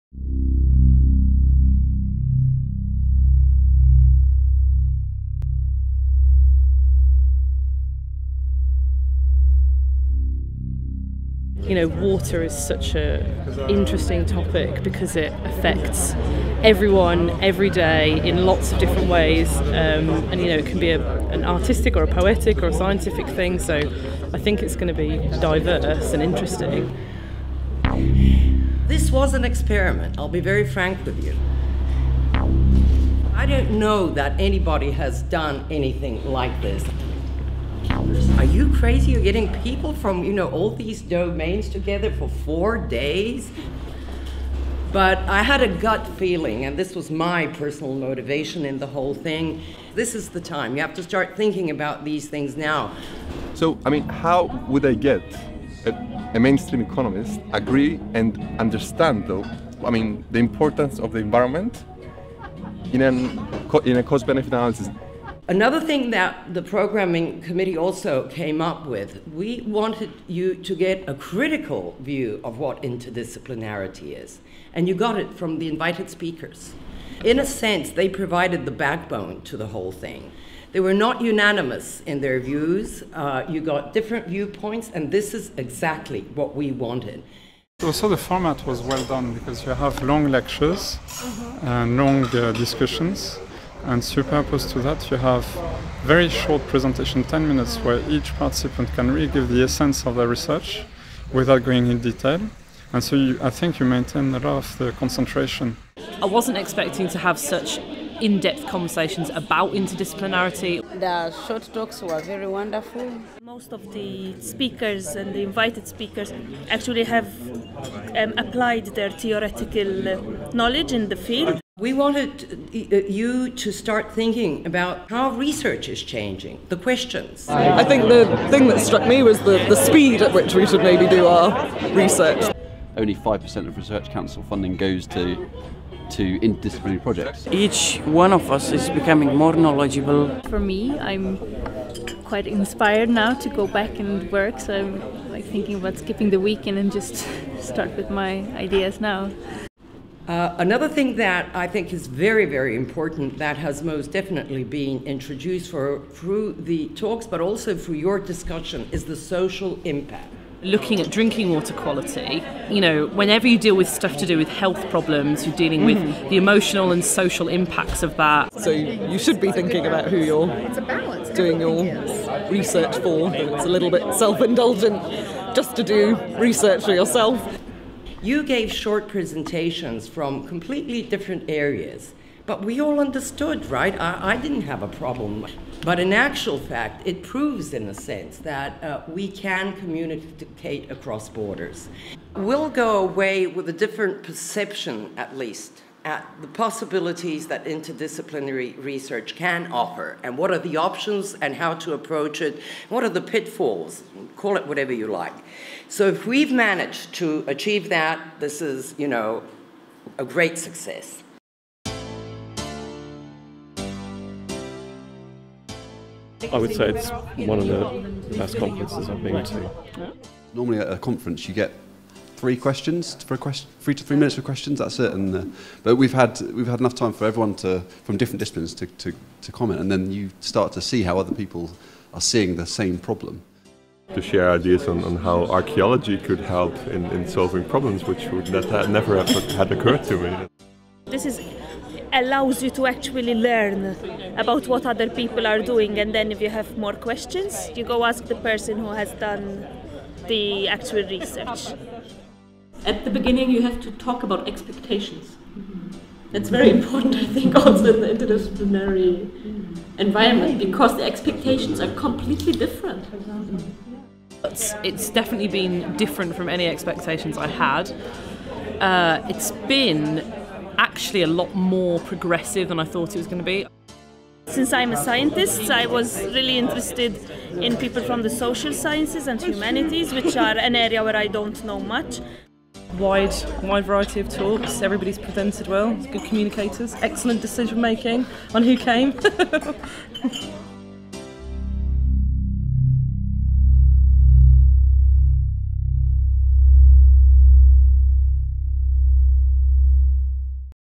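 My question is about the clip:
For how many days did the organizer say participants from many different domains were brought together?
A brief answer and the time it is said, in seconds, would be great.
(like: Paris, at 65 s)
4, at 42 s.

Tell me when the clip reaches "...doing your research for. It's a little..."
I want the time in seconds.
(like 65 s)
171 s.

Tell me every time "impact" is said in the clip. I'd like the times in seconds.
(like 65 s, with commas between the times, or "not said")
159 s, 167 s.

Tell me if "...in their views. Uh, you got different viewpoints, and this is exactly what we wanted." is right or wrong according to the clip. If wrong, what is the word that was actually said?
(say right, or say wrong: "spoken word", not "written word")
right.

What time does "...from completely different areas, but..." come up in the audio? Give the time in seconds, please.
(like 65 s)
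180 s.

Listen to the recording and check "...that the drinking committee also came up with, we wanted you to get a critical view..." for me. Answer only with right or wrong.
wrong.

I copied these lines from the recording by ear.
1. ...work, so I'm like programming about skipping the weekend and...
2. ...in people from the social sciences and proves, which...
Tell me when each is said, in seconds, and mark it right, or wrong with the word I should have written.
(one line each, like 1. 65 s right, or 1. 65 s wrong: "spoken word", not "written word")
1. 144 s wrong: "thinking", not "programming"
2. 277 s wrong: "humanities", not "proves".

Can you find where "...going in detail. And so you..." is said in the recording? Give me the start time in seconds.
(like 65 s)
101 s.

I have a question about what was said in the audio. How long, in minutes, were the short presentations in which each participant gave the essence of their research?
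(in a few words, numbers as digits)
10.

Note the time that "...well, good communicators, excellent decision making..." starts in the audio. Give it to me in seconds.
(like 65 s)
285 s.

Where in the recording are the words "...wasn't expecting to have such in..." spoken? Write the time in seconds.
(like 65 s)
106 s.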